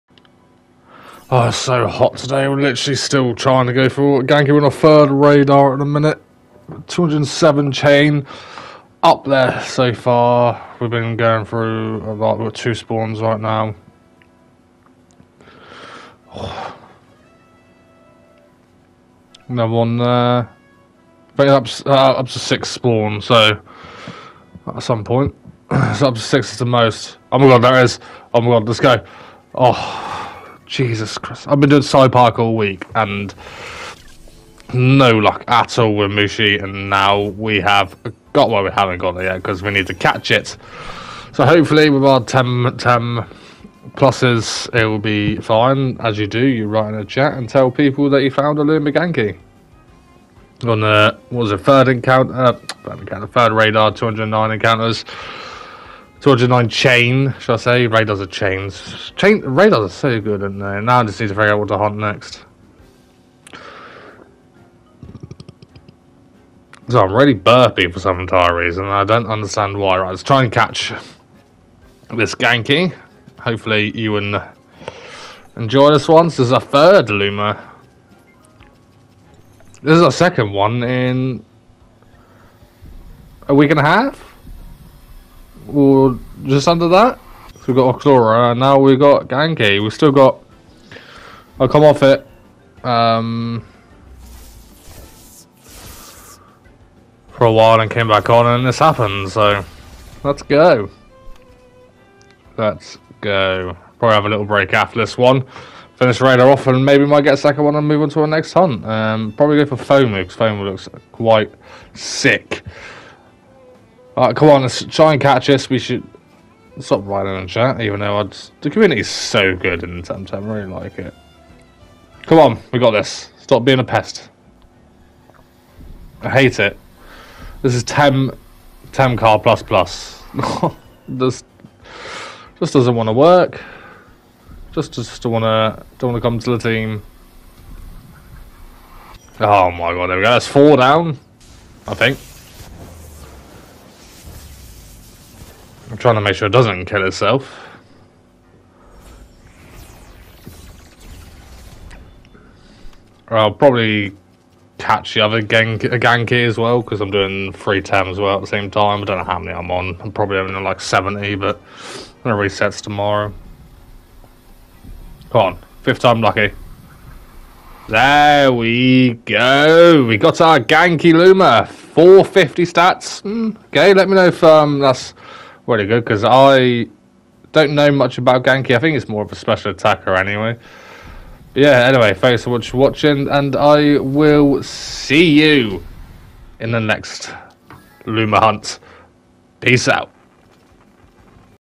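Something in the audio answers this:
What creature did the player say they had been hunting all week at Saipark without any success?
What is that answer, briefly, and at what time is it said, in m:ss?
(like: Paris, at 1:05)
Mushi, at 0:36.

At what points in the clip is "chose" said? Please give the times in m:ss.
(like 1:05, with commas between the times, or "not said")
not said.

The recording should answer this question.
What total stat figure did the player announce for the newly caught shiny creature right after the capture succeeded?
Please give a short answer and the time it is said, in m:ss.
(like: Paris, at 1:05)
450, at 2:51.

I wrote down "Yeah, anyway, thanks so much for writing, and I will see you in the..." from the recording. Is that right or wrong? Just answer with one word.
wrong.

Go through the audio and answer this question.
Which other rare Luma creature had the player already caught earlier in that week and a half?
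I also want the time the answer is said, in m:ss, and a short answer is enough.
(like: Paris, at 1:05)
Oxlora, at 1:27.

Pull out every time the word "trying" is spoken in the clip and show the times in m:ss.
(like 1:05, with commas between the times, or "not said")
0:03, 2:26.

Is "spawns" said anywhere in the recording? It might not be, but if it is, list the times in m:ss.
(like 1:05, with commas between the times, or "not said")
0:12, 0:22.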